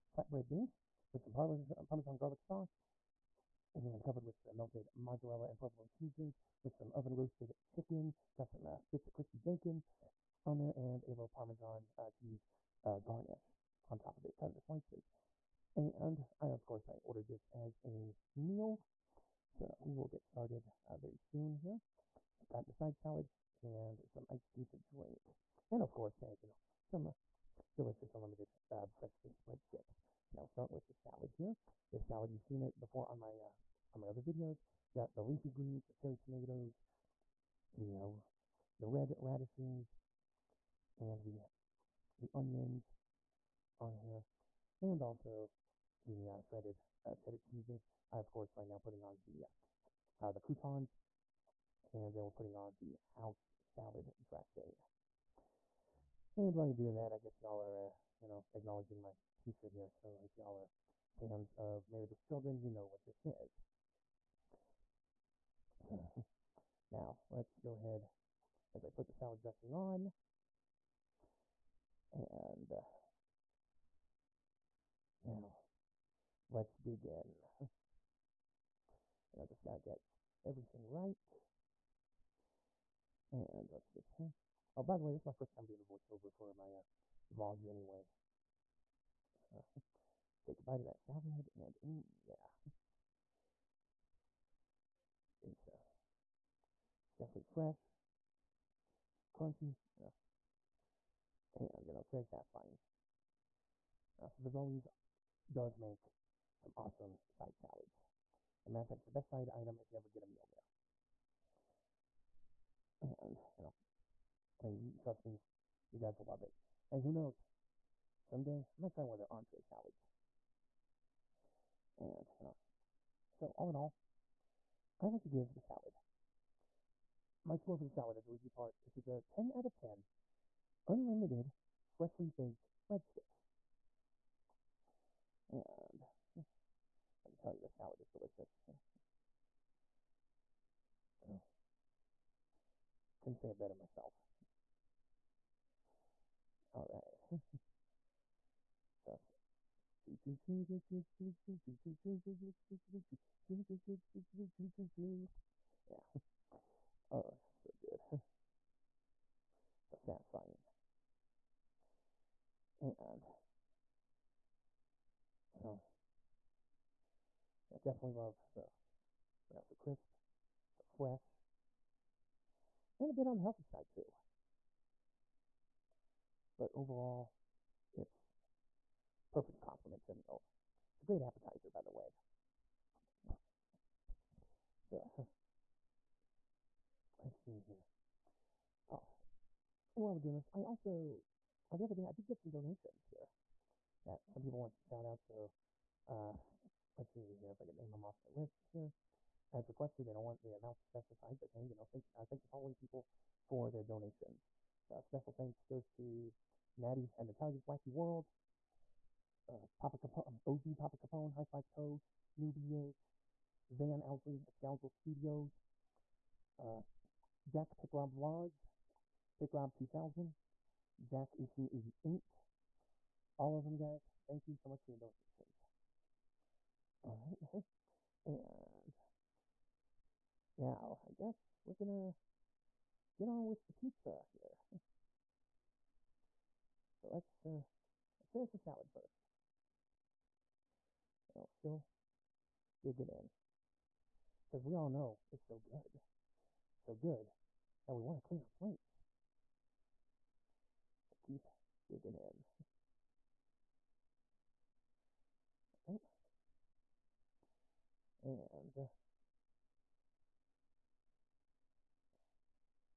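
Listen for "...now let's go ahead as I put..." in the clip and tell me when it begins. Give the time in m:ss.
1:06.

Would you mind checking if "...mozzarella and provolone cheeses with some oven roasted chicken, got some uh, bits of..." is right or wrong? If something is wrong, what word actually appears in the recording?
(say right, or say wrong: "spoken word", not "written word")
right.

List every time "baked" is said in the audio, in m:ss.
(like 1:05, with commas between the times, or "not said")
0:29, 2:12.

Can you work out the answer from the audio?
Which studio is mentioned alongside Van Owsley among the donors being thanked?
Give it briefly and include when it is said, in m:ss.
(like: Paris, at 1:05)
Scoundrel Studios, at 3:34.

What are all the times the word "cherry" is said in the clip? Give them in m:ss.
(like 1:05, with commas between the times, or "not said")
0:35.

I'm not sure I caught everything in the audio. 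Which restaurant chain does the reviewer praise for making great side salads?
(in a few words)
Fazoli's.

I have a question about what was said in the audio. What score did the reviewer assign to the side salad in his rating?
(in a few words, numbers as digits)
10 out of 10.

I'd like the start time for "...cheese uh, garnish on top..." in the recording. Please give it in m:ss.
0:12.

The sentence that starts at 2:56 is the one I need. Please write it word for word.
But overall, it's perfect complement to a meal.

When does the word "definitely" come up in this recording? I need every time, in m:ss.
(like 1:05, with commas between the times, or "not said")
1:37, 2:47.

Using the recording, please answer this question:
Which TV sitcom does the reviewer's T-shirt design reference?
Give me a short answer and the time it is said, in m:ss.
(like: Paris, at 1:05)
Married with Children, at 1:01.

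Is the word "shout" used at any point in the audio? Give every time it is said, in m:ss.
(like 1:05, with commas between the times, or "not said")
3:14.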